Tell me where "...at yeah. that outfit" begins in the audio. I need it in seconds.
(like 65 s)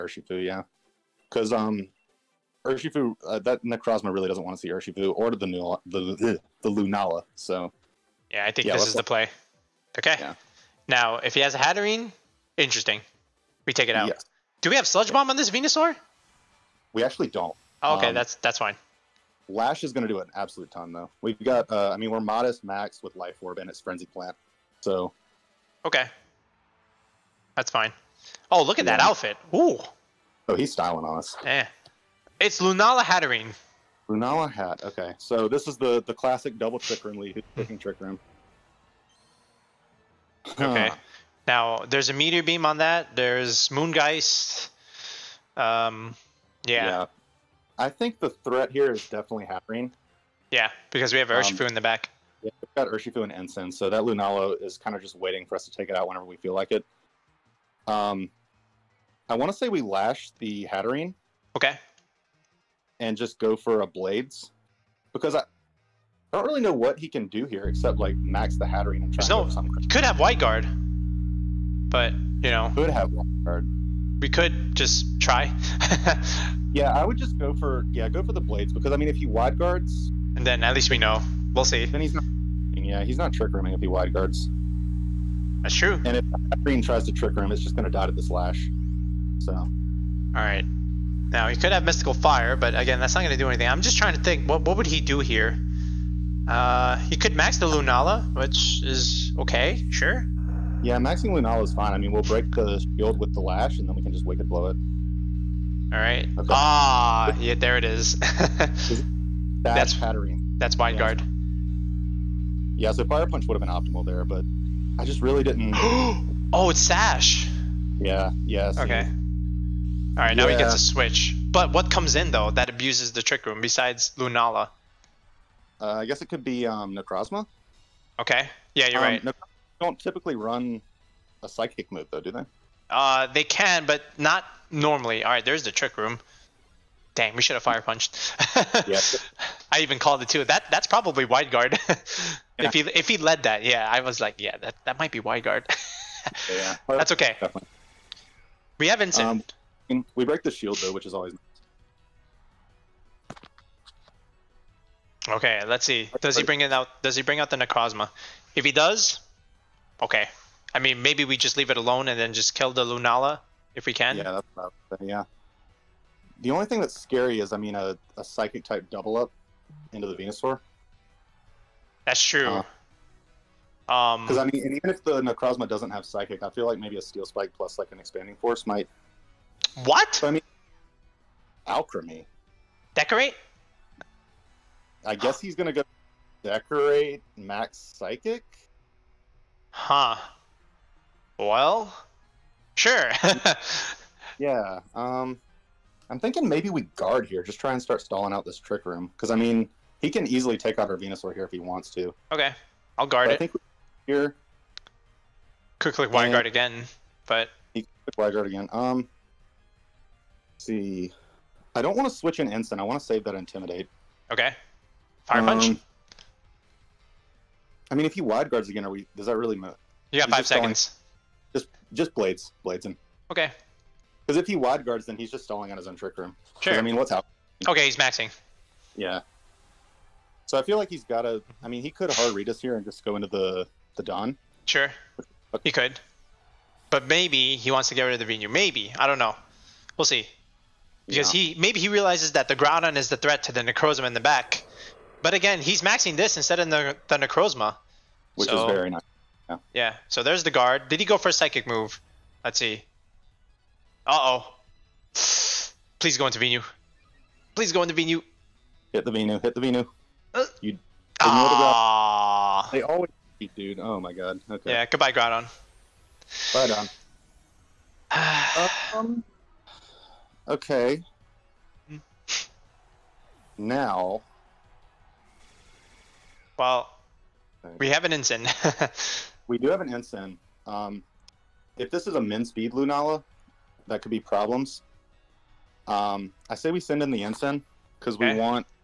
28 s.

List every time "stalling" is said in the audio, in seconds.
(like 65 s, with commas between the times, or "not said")
198 s, 225 s.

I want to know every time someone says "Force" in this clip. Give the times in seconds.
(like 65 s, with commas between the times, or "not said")
178 s.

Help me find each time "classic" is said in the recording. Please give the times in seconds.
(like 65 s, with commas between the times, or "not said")
36 s.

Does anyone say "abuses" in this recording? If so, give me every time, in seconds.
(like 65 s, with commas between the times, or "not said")
122 s.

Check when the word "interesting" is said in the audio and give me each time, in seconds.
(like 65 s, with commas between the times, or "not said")
12 s.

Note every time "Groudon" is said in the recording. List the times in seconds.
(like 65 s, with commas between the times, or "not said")
242 s, 265 s.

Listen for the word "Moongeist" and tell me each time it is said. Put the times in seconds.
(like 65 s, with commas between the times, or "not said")
43 s.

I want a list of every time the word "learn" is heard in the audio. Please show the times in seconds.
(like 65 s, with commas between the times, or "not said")
not said.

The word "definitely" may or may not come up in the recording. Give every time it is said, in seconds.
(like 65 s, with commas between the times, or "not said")
49 s, 147 s.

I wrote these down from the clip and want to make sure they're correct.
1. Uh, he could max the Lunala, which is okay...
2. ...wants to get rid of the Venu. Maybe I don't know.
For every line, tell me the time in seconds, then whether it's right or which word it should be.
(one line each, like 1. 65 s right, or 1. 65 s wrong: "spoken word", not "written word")
1. 96 s right
2. 237 s right.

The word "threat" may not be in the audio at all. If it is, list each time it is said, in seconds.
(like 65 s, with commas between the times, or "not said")
48 s, 243 s.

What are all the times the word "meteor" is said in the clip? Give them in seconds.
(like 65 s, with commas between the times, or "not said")
42 s.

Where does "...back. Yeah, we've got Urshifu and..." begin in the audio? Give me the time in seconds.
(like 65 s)
51 s.